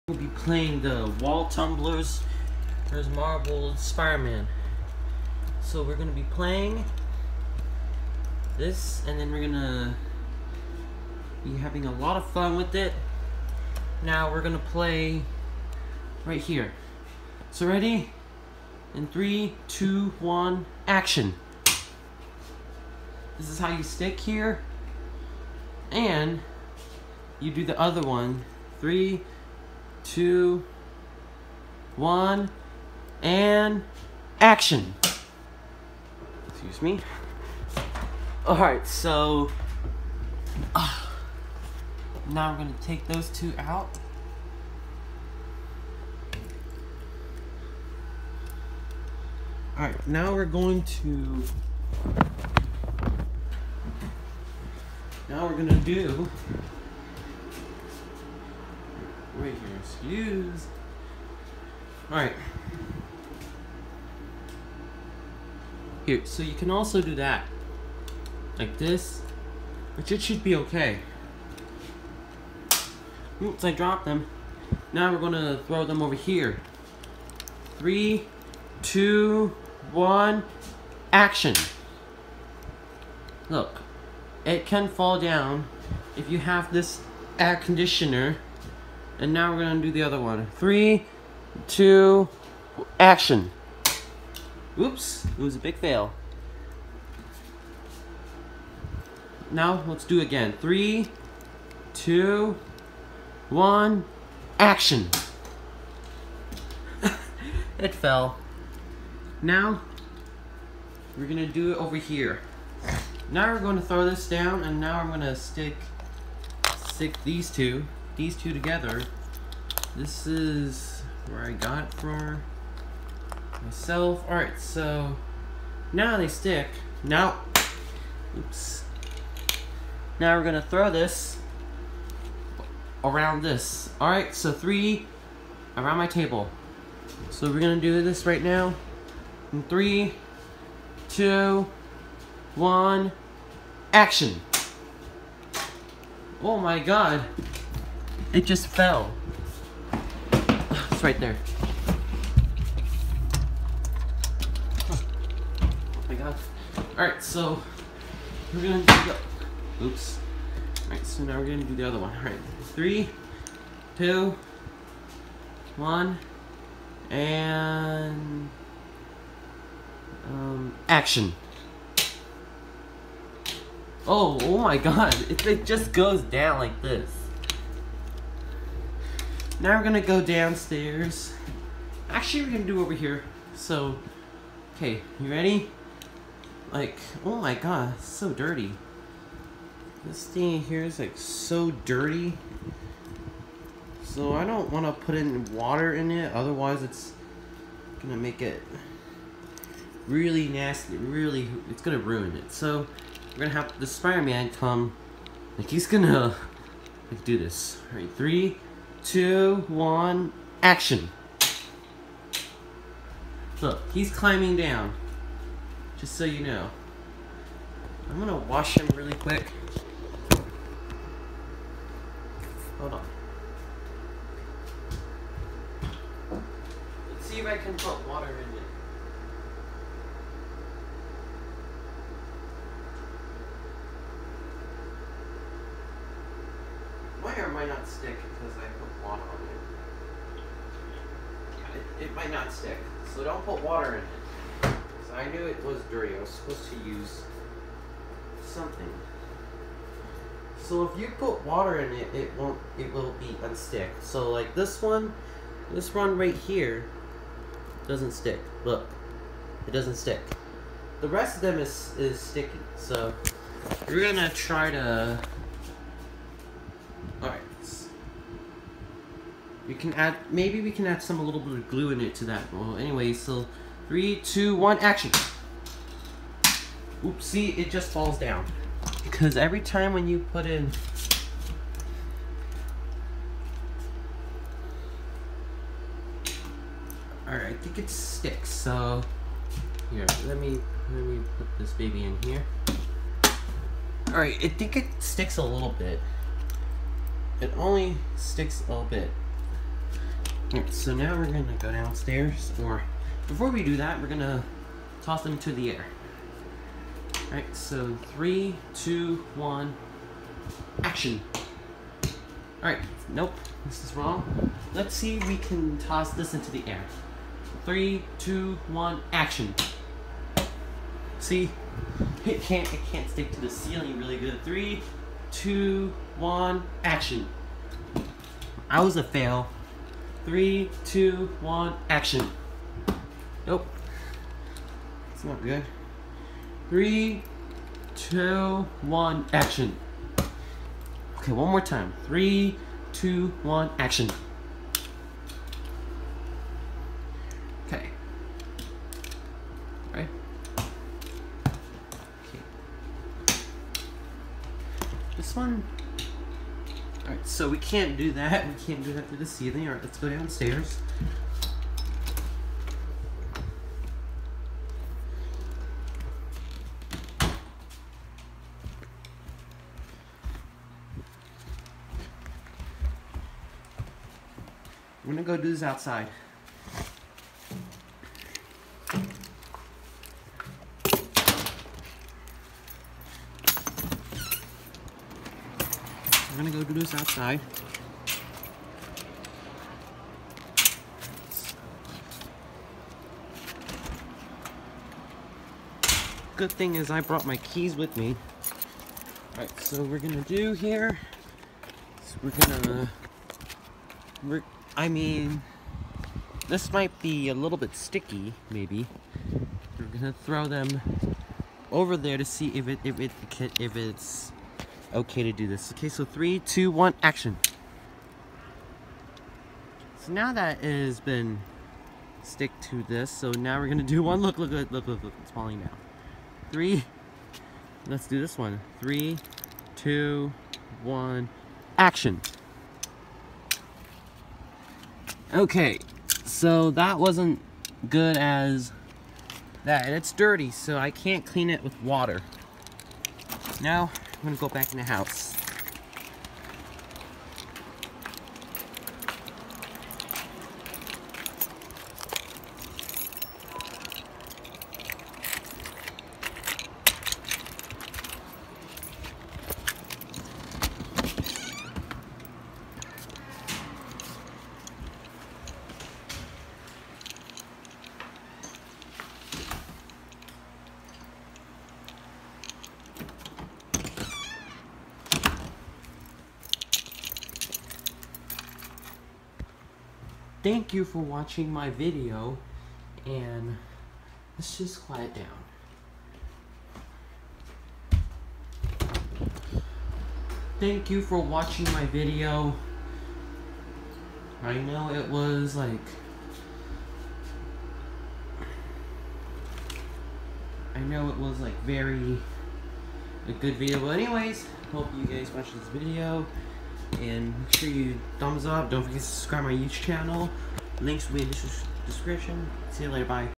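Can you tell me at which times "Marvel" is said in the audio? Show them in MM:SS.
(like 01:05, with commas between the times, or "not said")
00:03.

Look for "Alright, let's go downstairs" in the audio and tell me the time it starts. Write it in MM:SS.
05:59.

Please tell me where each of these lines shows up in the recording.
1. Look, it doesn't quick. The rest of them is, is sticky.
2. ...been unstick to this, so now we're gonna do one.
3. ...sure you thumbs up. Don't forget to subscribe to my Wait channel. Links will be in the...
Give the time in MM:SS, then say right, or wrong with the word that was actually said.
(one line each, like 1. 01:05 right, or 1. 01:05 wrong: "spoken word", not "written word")
1. 04:18 wrong: "stick", not "quick"
2. 07:00 wrong: "stick", not "unstick"
3. 08:27 wrong: "YouTube", not "Wait".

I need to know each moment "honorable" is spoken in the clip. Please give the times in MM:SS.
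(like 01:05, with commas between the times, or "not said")
not said.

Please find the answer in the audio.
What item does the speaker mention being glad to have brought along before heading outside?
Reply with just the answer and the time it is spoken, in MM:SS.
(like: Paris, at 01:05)
keys, at 06:37.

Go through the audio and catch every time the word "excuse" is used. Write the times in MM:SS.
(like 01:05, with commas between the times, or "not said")
00:36, 00:59.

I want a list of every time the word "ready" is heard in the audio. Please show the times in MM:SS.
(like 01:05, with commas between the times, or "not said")
00:17, 03:05.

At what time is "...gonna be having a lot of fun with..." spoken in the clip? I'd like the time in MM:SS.
00:09.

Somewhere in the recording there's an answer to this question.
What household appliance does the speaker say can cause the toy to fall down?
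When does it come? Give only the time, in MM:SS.
01:27.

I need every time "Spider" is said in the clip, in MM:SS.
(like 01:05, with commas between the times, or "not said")
00:03, 03:23.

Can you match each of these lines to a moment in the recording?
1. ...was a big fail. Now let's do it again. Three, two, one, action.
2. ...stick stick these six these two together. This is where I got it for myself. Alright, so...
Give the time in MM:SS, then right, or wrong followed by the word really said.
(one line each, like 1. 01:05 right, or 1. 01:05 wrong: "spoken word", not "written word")
1. 01:35 right
2. 01:55 wrong: "two", not "six".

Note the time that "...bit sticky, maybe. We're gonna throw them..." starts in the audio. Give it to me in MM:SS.
06:47.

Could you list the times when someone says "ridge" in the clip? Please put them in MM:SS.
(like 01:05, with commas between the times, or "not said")
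not said.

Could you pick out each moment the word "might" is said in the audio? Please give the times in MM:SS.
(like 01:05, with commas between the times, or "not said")
03:57, 04:02, 06:46.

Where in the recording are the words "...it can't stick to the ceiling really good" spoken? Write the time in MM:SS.
05:22.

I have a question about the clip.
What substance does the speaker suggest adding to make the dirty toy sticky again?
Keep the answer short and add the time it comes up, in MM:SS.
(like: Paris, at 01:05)
glue, at 04:31.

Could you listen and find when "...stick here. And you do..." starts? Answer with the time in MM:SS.
00:23.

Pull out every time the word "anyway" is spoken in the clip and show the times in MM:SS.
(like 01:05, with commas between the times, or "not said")
04:32, 08:23.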